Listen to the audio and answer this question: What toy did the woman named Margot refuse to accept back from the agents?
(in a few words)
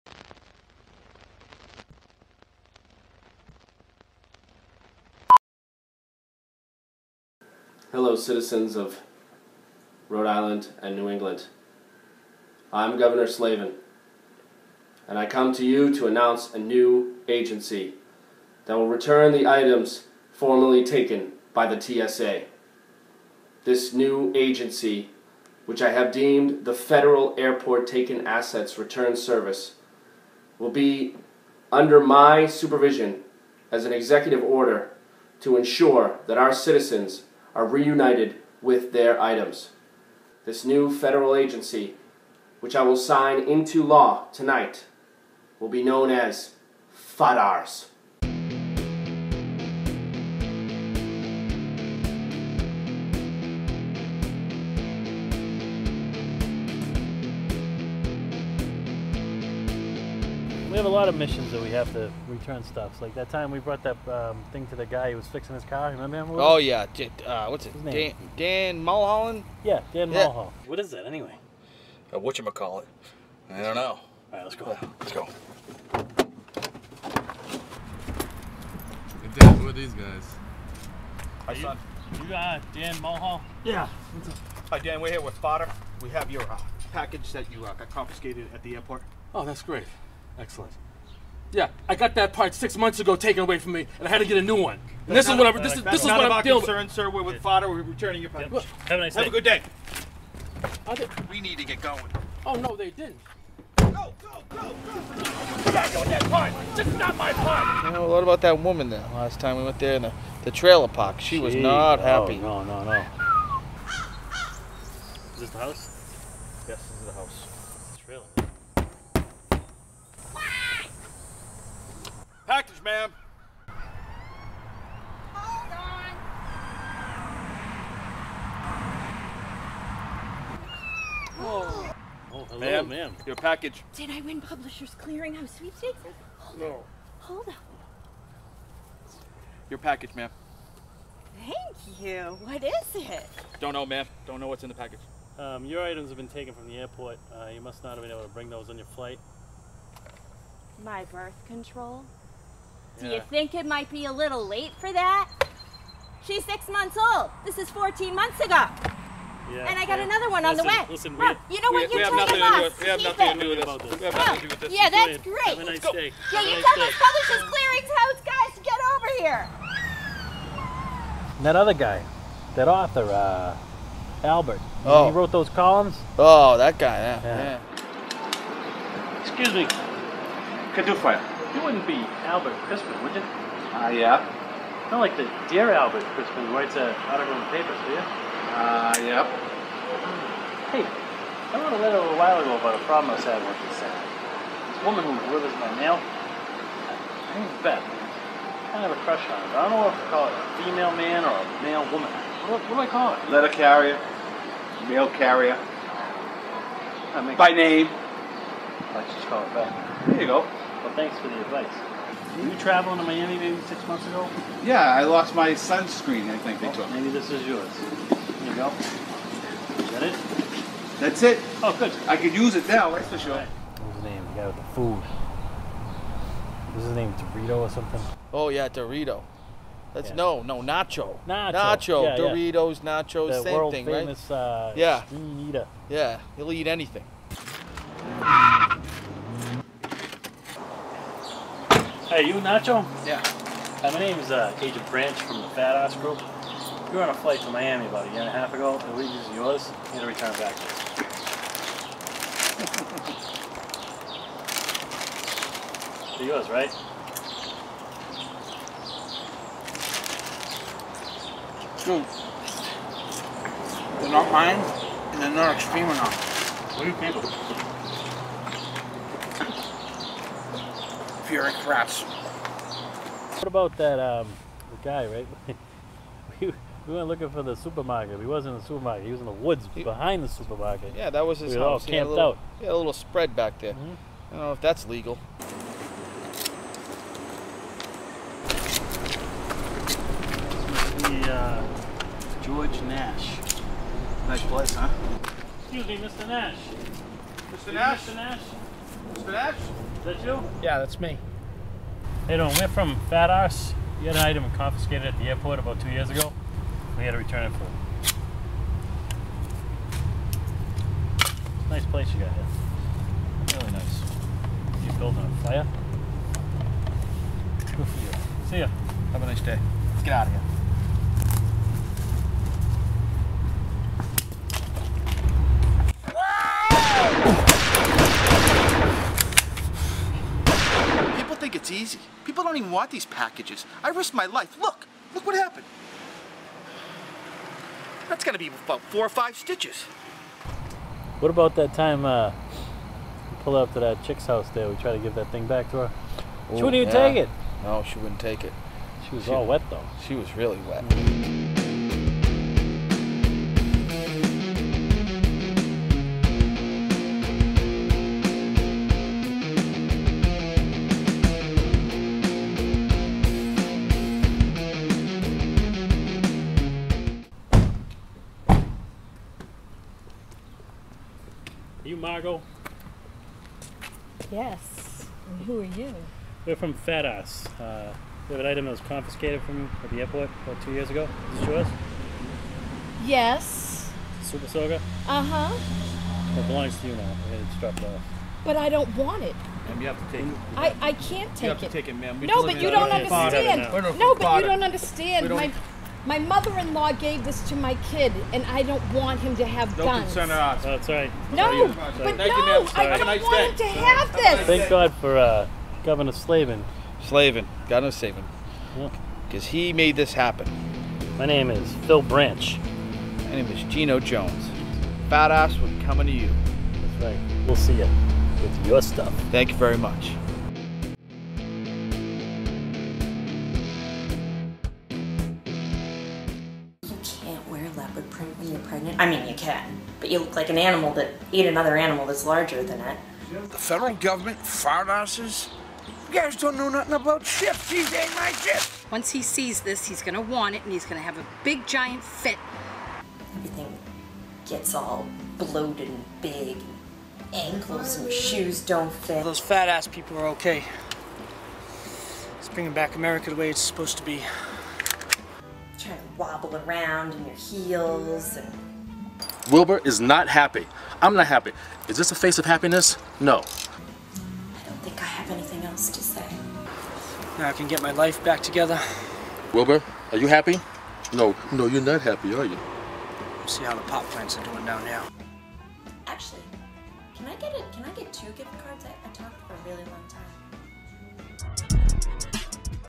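Super Soaker.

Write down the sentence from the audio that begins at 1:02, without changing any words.
So like that time we brought that um, thing to the guy who was fixing his car.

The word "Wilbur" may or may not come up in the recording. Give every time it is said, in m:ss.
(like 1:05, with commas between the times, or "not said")
7:39, 7:49.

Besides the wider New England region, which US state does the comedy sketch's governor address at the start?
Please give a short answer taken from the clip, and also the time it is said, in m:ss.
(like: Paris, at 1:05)
Rhode Island, at 0:10.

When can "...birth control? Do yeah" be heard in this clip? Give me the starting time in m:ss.
2:31.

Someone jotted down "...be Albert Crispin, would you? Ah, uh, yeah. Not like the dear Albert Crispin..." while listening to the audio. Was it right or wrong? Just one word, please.
right.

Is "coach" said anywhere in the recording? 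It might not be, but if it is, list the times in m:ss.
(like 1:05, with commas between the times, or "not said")
not said.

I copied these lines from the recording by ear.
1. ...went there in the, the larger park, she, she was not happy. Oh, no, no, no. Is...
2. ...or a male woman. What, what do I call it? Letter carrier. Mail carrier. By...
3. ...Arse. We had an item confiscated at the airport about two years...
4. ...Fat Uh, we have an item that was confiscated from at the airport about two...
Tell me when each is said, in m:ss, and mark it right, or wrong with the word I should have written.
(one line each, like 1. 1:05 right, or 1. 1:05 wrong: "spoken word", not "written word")
1. 1:49 wrong: "trailer", not "larger"
2. 3:21 right
3. 5:03 right
4. 6:16 right.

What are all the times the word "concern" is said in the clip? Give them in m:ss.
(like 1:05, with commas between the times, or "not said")
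1:36, 6:40.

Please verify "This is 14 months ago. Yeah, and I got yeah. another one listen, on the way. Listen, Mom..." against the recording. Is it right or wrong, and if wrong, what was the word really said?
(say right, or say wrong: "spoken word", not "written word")
right.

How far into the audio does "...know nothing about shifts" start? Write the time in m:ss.
7:16.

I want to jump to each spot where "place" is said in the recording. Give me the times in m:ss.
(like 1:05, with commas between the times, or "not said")
4:54, 5:11.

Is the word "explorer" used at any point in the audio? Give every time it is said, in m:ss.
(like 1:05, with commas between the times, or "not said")
not said.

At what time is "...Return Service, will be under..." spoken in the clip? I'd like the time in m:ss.
0:28.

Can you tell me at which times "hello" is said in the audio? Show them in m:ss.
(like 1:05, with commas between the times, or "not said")
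0:07, 2:12.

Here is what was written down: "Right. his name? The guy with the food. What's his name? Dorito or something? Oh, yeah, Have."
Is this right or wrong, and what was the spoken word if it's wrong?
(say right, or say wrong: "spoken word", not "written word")
wrong: "Dorito", not "Have".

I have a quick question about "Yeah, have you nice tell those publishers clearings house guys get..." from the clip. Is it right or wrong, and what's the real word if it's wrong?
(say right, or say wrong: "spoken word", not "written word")
right.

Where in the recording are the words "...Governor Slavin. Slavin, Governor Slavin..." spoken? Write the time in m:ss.
6:45.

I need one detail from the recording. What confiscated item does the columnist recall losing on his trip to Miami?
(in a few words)
sunscreen.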